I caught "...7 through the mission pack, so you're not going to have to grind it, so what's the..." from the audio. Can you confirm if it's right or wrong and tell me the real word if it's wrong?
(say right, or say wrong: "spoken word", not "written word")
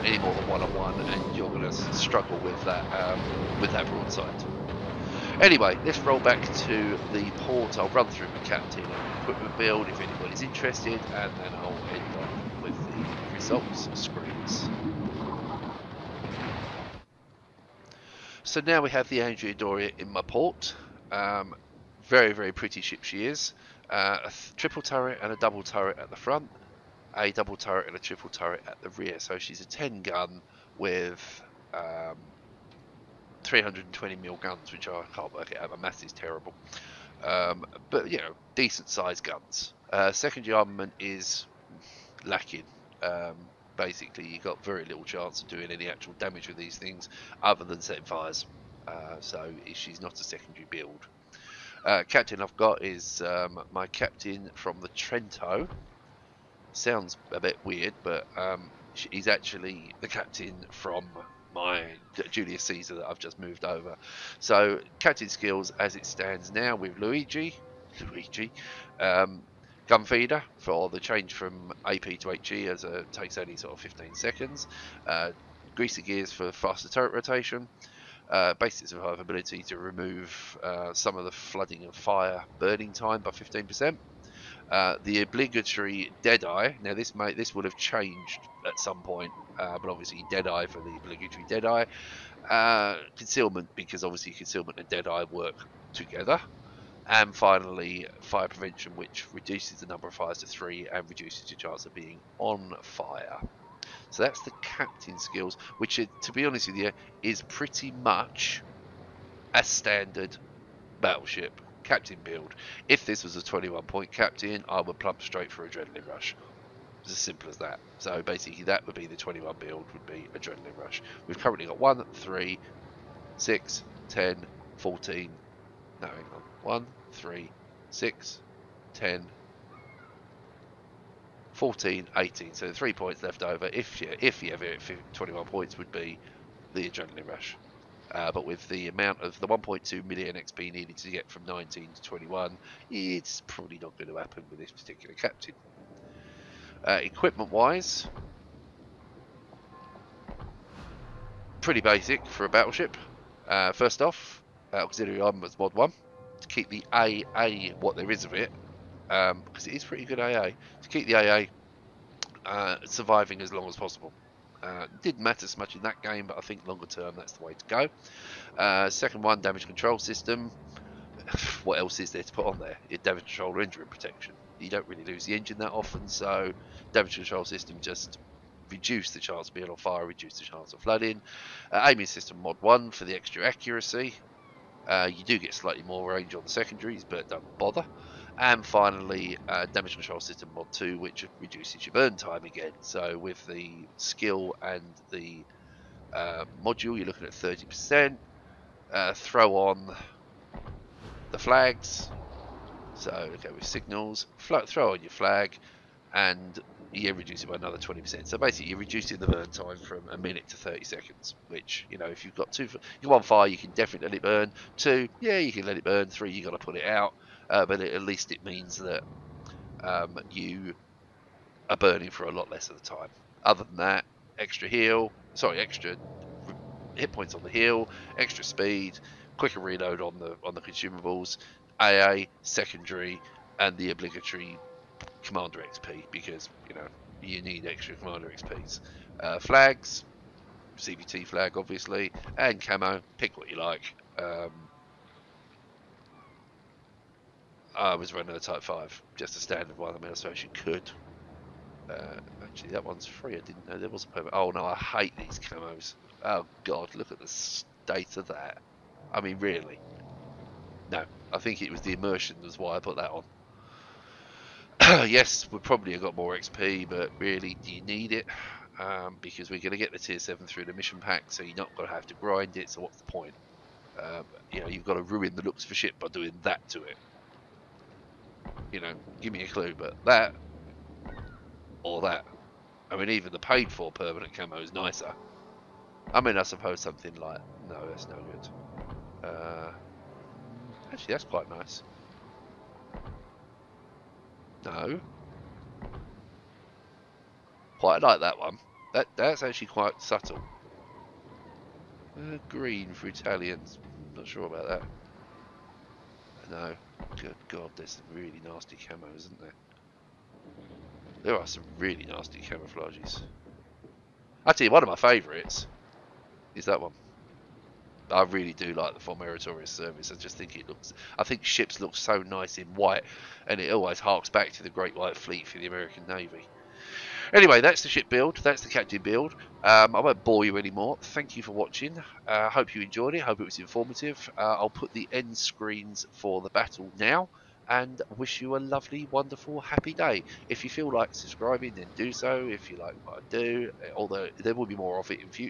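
right.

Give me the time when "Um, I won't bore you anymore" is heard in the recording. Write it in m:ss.
5:29.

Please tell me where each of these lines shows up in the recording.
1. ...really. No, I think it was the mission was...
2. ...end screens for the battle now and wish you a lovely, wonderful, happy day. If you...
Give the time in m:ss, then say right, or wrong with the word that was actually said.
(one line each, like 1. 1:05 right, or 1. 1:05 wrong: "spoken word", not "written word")
1. 4:19 wrong: "immersion", not "mission"
2. 5:35 right.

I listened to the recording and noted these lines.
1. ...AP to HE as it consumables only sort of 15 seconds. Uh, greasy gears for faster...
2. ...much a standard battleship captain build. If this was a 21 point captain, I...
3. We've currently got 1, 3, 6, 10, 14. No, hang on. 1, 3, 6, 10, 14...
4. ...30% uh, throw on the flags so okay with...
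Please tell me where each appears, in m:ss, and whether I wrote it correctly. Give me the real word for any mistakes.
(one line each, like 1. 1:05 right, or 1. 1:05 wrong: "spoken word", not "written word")
1. 1:11 wrong: "takes", not "consumables"
2. 1:47 right
3. 2:01 right
4. 3:17 right.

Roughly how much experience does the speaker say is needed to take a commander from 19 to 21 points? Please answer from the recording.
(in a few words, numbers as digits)
1.2 million.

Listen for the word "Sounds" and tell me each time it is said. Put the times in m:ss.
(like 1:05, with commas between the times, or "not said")
0:56.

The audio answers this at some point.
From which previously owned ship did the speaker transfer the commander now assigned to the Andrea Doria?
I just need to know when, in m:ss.
1:02.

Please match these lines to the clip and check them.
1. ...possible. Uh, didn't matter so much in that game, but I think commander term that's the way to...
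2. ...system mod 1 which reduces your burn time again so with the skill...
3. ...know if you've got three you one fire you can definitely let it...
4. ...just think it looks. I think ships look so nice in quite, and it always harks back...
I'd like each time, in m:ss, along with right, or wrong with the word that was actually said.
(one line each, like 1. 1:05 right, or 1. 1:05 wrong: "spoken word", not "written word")
1. 2:43 wrong: "longer", not "commander"
2. 3:10 wrong: "2", not "1"
3. 3:31 wrong: "two", not "three"
4. 5:20 wrong: "white", not "quite".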